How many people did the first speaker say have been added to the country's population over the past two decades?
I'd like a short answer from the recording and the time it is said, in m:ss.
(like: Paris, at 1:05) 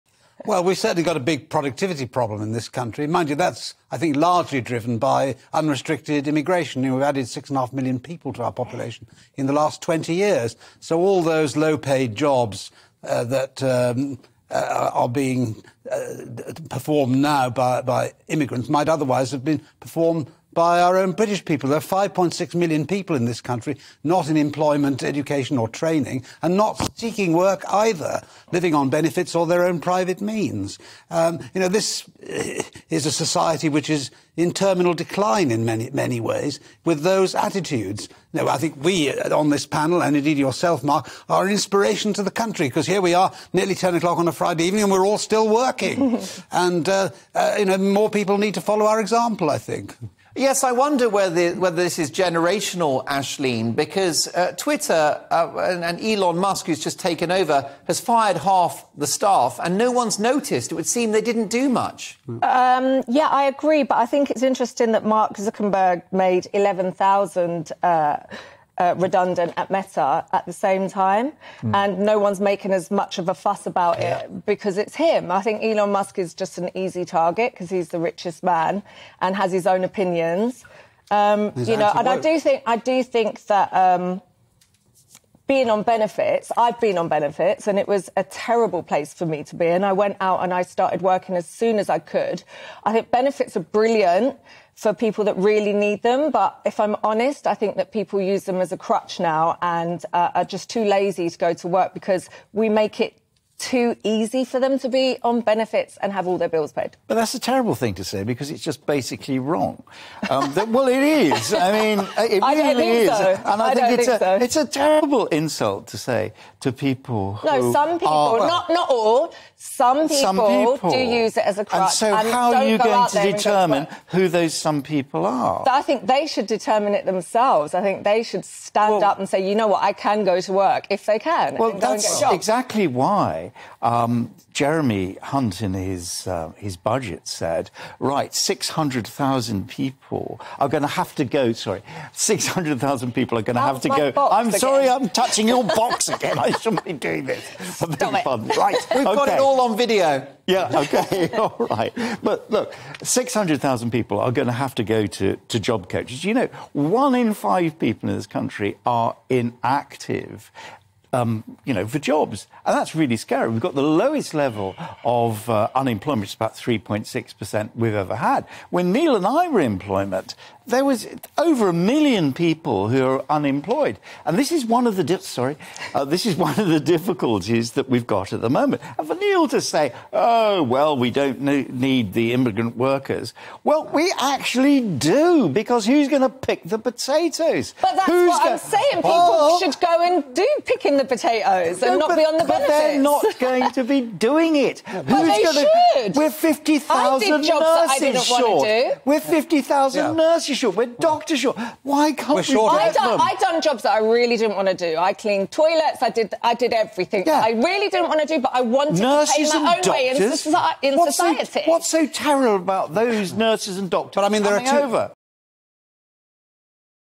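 6.5 million, at 0:07.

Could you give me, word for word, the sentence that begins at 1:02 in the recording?
Um, yeah, I agree, but I think it's interesting that Mark Zuckerberg made 11,000.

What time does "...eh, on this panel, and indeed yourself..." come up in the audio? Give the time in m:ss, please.
0:39.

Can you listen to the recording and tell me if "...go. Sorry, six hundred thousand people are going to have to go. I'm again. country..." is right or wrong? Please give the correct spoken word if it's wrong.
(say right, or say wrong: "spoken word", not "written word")
wrong: "sorry", not "country".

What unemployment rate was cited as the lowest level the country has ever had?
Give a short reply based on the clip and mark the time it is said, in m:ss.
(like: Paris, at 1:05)
3.6%, at 2:46.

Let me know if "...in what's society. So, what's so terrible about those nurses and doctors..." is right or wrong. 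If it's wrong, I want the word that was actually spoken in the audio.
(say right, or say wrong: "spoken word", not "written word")
right.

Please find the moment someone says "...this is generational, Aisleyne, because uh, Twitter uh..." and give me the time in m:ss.
0:51.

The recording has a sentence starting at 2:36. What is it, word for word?
You know, one in five people in this country are inactive, um, you know, for jobs.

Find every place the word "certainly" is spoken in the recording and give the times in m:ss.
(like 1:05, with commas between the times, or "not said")
0:00.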